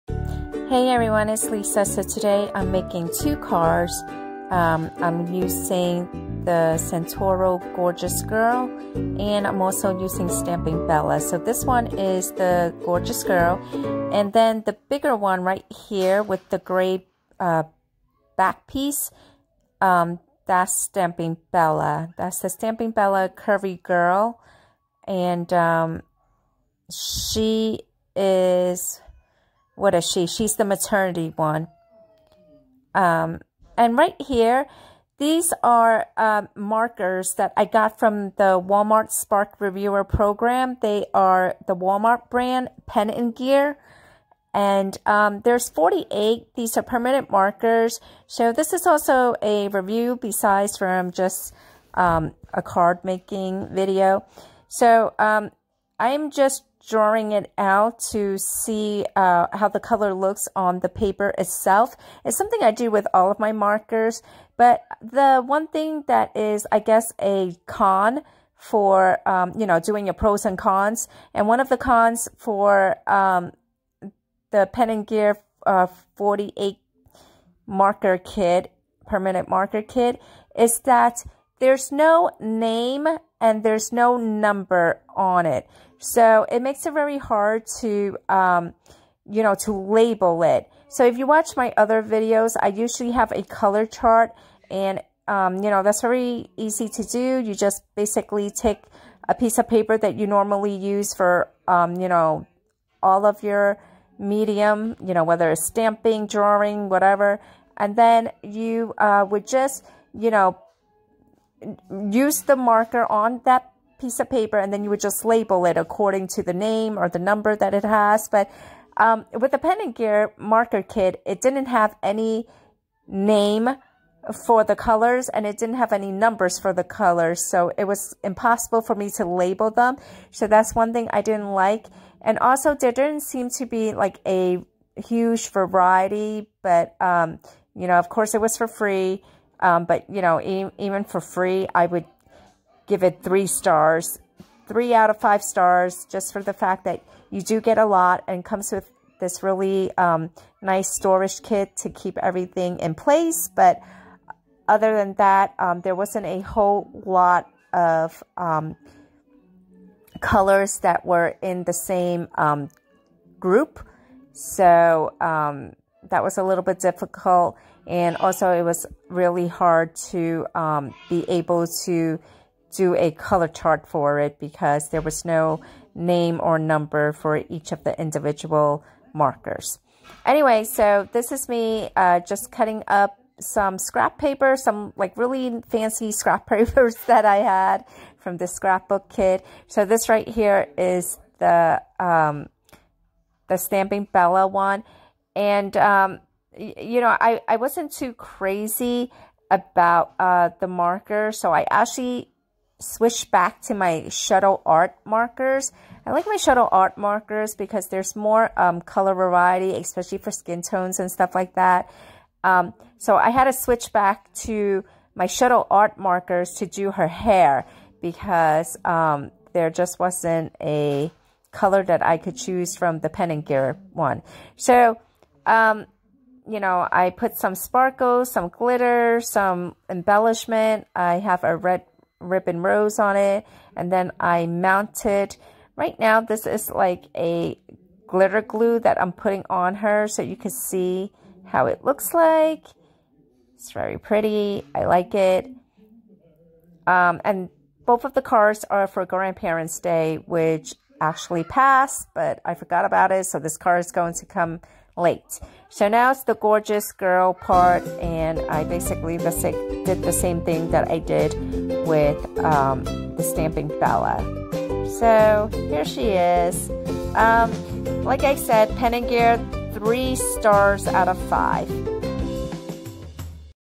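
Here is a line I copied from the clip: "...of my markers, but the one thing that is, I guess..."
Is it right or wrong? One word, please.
right.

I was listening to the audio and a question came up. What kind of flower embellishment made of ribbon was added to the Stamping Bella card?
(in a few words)
red ribbon rose.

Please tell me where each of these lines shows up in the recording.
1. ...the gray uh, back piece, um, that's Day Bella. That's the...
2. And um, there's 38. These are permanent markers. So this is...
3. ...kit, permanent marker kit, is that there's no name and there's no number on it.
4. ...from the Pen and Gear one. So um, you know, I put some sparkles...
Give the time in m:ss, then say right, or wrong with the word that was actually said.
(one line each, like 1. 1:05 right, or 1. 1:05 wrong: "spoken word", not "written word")
1. 0:16 wrong: "Stamping", not "Day"
2. 0:44 wrong: "48", not "38"
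3. 1:18 right
4. 3:42 right.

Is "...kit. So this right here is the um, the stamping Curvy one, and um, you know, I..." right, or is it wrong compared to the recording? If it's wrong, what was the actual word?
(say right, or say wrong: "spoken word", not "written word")
wrong: "Bella", not "Curvy".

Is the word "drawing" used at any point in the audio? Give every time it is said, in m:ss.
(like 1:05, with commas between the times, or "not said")
0:56, 1:46.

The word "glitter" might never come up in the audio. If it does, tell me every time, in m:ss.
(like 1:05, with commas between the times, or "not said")
3:48, 3:58.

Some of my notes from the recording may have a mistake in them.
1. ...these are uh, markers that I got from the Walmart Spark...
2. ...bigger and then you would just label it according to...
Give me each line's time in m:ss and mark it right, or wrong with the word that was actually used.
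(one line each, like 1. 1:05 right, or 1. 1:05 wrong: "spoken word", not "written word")
1. 0:35 right
2. 1:54 wrong: "paper", not "bigger".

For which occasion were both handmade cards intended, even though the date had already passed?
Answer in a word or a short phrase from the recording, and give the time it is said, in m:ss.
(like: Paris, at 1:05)
Grandparents' Day, at 4:09.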